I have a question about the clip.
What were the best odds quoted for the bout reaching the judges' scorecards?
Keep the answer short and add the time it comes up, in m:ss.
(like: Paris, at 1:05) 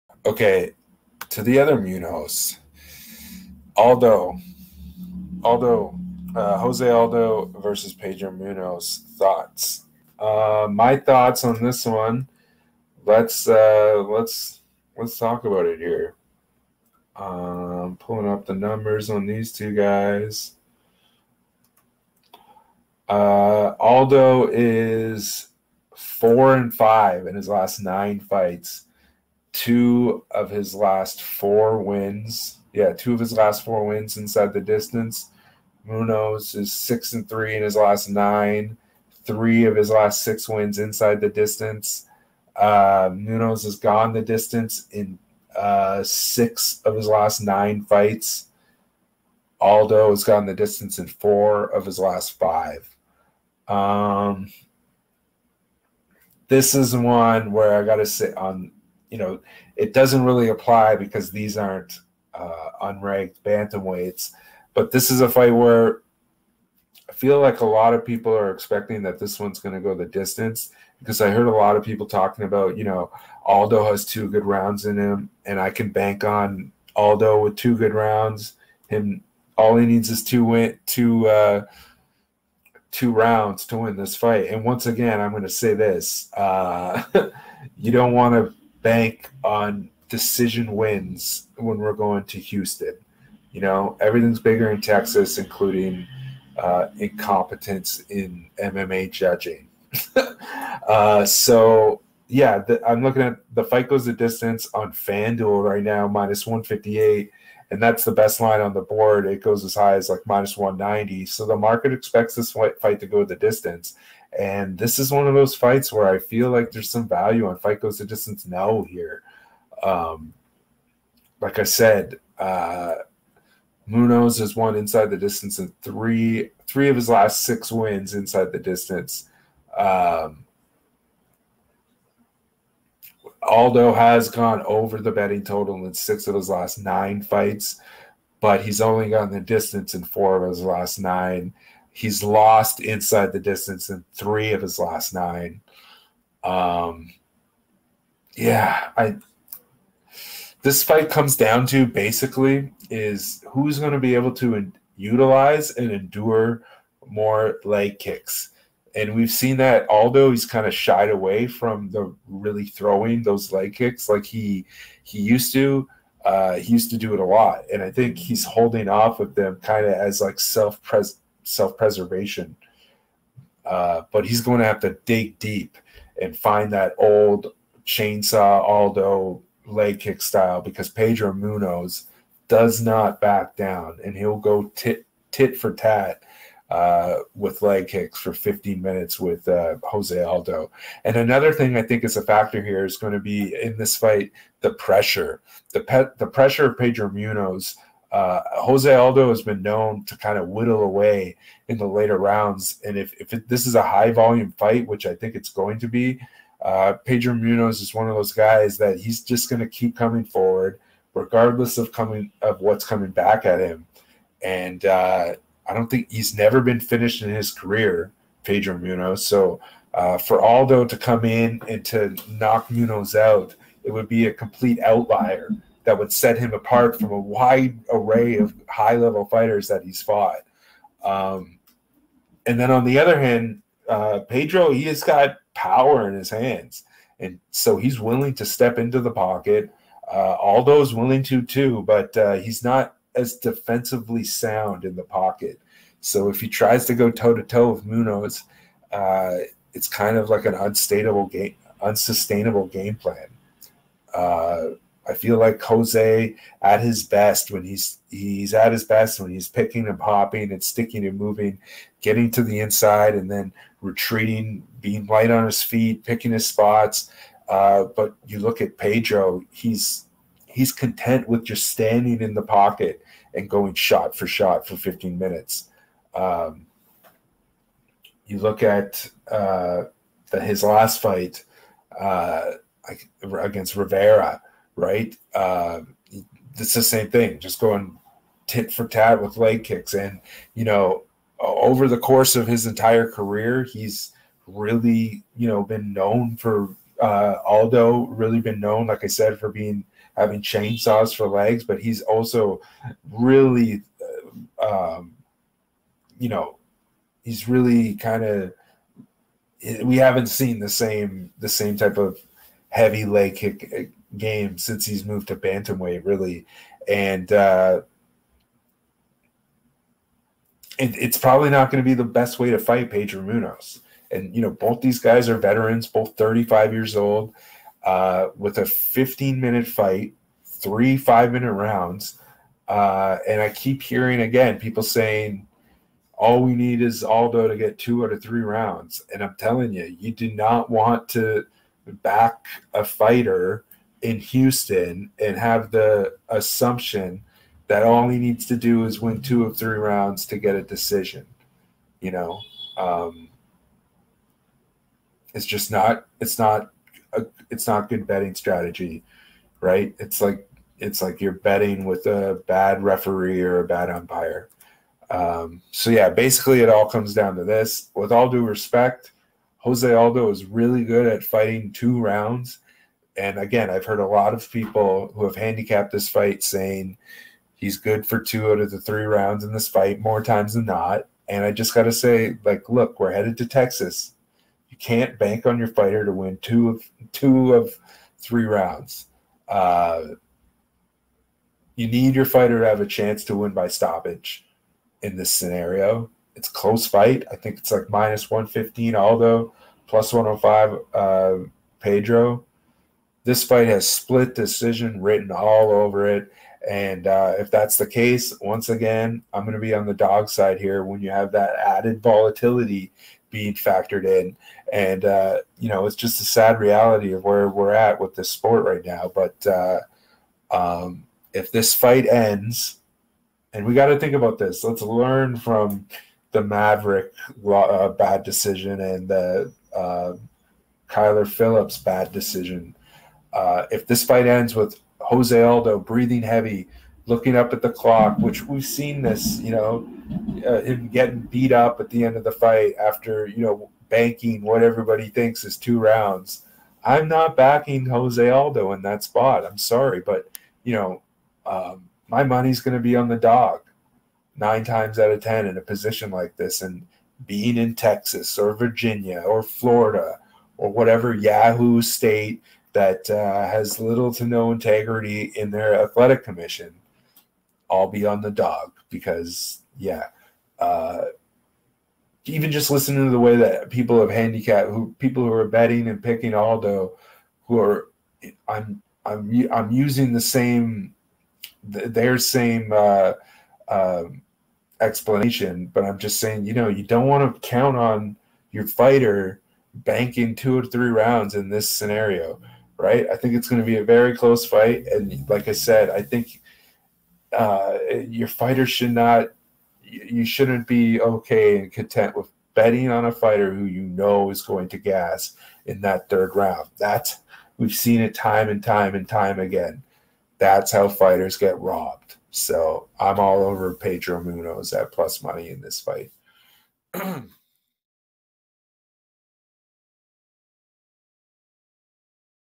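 -158, at 1:46.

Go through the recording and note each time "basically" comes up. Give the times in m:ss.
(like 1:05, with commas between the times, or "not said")
2:31, 6:06.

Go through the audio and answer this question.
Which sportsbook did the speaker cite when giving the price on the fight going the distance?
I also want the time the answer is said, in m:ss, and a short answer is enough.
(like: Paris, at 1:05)
FanDuel, at 1:44.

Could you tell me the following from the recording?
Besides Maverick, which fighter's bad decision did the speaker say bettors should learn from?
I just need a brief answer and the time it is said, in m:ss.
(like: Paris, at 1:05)
Kyler Phillips, at 7:10.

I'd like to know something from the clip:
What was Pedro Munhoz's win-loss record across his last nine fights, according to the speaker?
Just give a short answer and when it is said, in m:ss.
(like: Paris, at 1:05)
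6 and 3, at 0:36.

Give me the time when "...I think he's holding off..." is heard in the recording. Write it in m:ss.
2:47.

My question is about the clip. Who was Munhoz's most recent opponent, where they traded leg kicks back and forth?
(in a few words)
Rivera.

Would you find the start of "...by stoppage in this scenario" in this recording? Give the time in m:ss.
6:33.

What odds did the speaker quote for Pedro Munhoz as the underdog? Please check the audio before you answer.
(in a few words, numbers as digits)
+105.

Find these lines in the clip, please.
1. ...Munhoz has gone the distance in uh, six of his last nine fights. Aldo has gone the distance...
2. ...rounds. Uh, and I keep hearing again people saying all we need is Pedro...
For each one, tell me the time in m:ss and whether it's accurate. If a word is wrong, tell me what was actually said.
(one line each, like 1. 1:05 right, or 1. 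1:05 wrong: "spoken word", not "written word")
1. 0:43 right
2. 5:31 wrong: "Aldo", not "Pedro".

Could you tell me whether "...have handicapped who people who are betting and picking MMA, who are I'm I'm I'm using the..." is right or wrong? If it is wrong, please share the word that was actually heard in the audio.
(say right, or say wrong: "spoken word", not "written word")
wrong: "Aldo", not "MMA".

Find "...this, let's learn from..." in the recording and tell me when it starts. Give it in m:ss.
7:04.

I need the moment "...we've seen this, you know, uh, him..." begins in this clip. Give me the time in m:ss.
7:18.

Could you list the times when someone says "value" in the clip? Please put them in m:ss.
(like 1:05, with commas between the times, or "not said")
1:57.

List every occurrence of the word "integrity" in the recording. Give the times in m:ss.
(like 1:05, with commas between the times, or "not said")
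7:44.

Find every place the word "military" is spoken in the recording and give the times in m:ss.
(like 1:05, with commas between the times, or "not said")
not said.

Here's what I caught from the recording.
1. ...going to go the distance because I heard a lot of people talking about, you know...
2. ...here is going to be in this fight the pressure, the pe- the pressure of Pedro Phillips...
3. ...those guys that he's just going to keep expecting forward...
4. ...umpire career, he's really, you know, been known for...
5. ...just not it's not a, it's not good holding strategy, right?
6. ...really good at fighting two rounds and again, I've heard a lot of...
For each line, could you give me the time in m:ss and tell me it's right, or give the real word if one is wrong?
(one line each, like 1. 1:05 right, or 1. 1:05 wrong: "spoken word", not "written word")
1. 1:09 right
2. 3:12 wrong: "Munhoz", not "Phillips"
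3. 3:28 wrong: "coming", not "expecting"
4. 4:52 wrong: "entire", not "umpire"
5. 5:55 wrong: "betting", not "holding"
6. 6:10 right.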